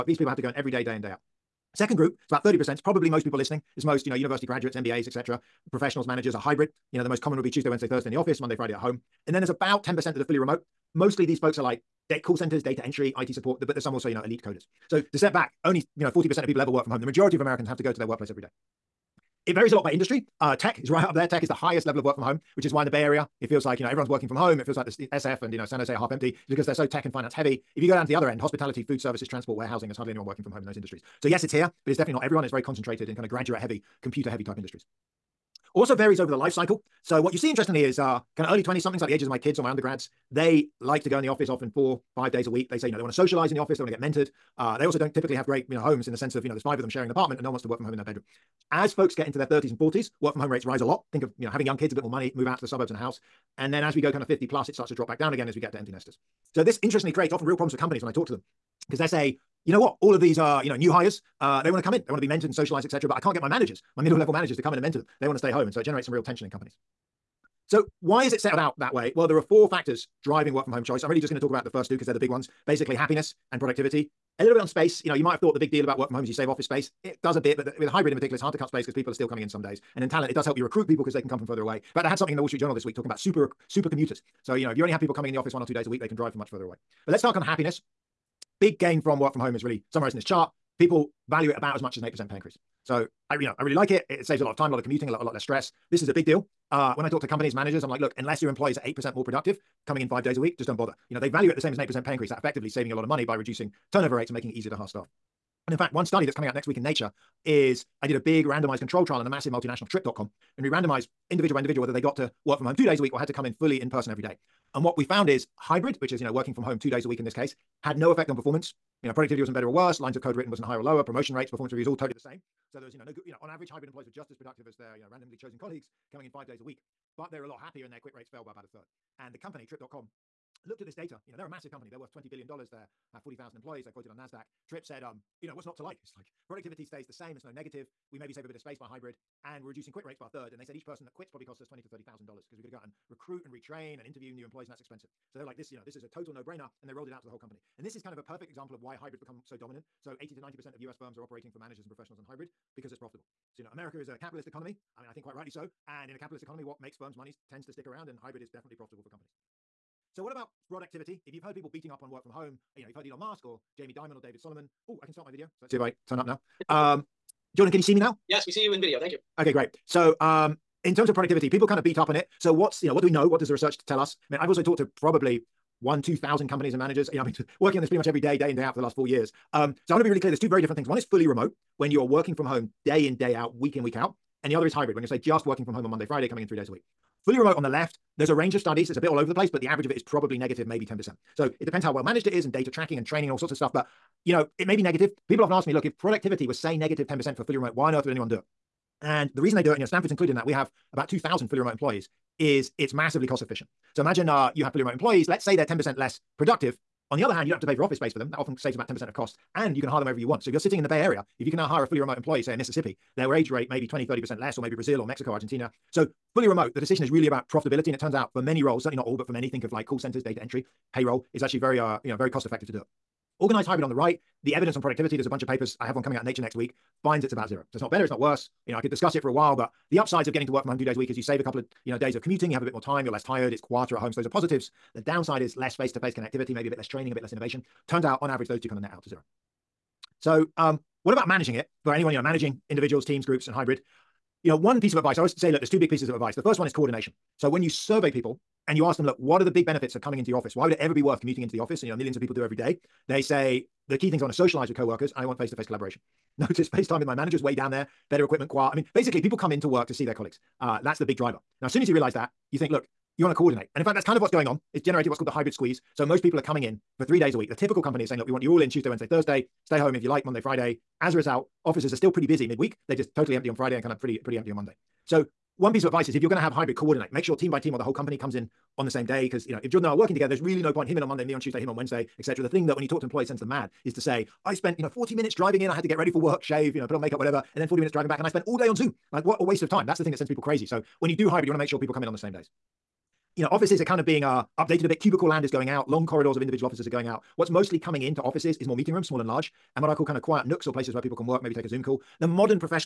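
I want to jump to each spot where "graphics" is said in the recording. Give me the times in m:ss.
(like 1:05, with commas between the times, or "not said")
not said.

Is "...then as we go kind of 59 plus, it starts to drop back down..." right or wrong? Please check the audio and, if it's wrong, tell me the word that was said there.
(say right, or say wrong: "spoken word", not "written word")
wrong: "50", not "59".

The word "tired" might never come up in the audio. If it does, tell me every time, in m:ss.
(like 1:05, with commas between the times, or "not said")
3:53.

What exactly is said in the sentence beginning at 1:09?
Well, there are four factors driving work from home choice.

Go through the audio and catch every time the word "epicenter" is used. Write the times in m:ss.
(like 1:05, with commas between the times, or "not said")
not said.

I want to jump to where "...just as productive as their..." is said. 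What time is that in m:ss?
2:04.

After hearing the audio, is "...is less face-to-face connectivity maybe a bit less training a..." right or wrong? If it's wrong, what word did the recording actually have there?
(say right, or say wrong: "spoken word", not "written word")
right.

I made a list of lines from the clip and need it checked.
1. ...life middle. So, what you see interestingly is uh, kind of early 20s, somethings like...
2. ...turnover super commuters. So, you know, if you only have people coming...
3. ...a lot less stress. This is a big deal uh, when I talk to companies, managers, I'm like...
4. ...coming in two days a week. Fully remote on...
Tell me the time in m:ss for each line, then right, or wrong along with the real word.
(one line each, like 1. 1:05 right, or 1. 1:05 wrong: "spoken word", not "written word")
1. 0:36 wrong: "cycle", not "middle"
2. 1:23 wrong: "super", not "turnover"
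3. 1:35 right
4. 3:06 wrong: "three", not "two".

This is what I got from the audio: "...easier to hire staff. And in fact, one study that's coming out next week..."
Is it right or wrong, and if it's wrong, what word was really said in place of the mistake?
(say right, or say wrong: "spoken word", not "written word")
right.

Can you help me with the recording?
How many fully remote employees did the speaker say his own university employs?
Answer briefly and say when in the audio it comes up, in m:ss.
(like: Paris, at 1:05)
About 2,000, at 3:20.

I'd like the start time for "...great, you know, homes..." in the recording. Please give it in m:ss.
0:45.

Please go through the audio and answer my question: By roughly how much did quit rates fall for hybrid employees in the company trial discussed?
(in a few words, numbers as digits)
About a third.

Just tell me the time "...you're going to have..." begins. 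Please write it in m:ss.
4:36.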